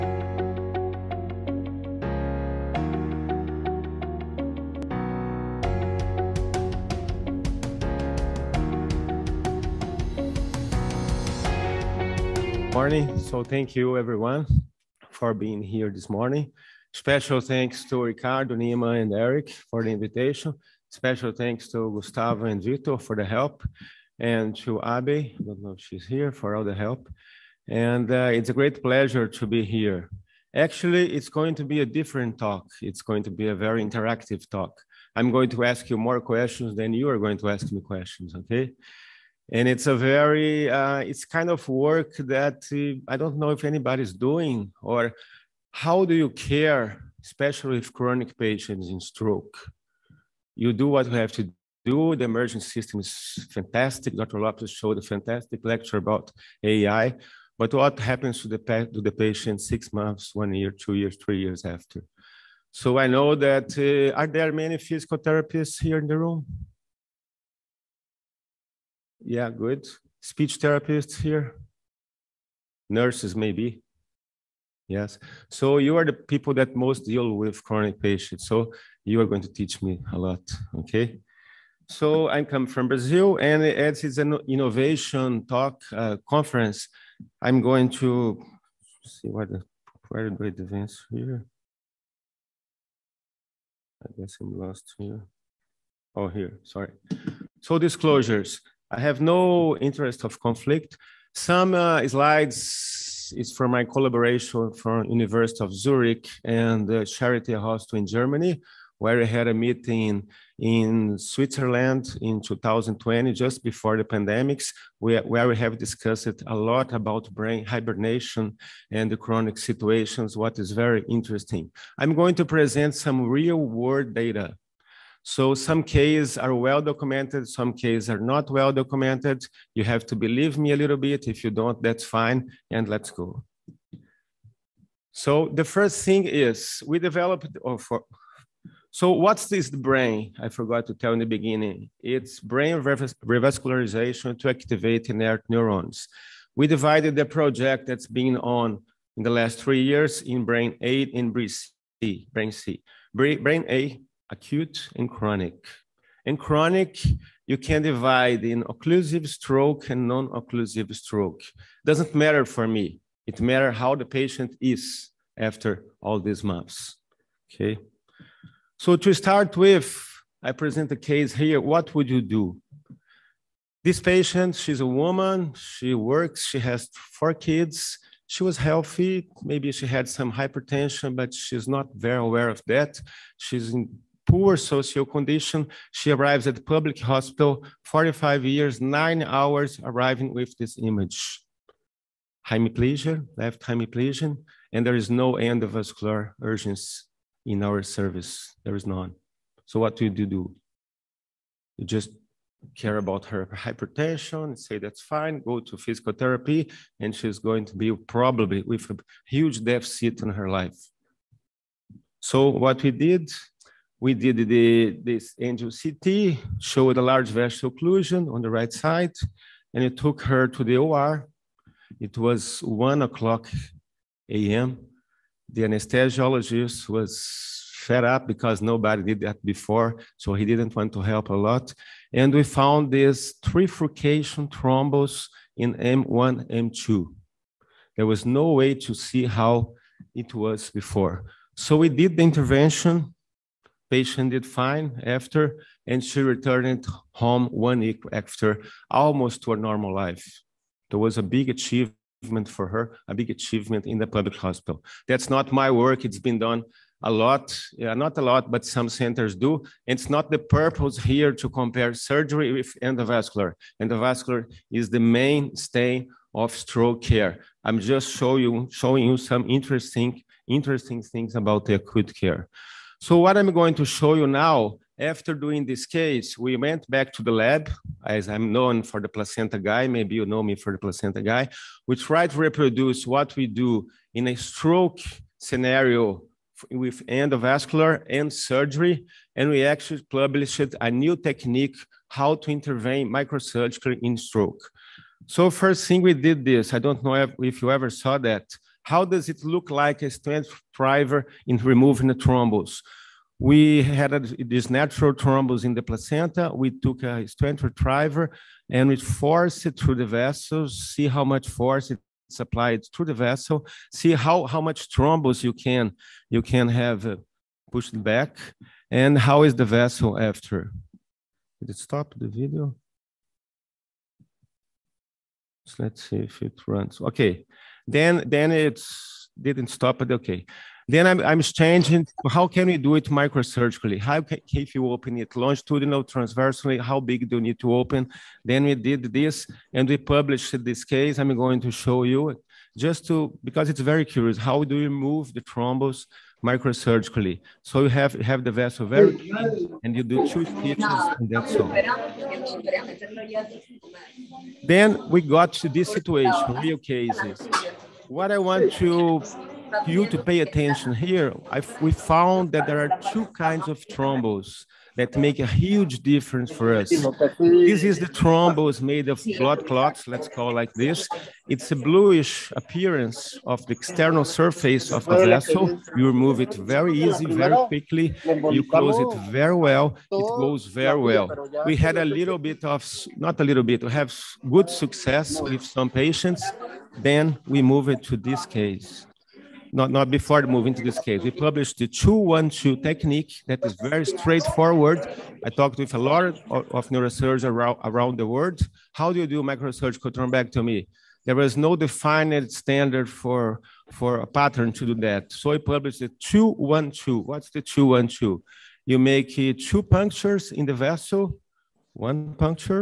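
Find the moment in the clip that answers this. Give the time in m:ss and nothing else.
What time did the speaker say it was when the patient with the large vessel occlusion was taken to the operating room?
3:42.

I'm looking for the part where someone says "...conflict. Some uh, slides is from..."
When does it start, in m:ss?
1:40.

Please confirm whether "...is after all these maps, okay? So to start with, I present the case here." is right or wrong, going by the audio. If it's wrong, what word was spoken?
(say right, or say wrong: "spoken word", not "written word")
right.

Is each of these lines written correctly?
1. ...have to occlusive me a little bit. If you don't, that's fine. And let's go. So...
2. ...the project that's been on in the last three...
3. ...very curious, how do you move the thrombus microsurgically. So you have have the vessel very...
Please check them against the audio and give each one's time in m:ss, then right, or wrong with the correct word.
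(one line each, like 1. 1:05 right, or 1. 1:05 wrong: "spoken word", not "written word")
1. 2:09 wrong: "believe", not "occlusive"
2. 2:27 right
3. 5:43 right.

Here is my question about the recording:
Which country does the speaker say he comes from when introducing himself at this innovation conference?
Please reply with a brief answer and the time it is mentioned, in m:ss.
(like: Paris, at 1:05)
Brazil, at 1:22.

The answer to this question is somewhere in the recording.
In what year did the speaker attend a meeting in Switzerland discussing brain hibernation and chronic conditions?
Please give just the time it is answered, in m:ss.
1:52.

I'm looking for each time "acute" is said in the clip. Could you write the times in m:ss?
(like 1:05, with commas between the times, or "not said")
2:34, 4:31.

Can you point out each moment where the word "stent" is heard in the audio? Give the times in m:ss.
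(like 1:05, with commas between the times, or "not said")
5:00, 5:07.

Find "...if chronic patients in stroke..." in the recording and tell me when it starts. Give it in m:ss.
0:47.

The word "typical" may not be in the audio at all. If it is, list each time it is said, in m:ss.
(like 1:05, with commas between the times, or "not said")
not said.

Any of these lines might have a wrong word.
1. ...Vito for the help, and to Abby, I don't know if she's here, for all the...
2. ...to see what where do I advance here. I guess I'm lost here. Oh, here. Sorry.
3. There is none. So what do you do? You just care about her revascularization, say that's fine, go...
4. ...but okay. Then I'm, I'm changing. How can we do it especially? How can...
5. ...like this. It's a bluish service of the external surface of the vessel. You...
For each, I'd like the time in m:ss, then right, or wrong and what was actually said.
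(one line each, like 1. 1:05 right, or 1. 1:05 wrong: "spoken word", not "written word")
1. 0:22 right
2. 1:27 right
3. 3:18 wrong: "hypertension", not "revascularization"
4. 5:29 wrong: "microsurgically", not "especially"
5. 6:10 wrong: "appearance", not "service".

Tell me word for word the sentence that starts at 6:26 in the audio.
Then we move it to this case not, not before moving to this case.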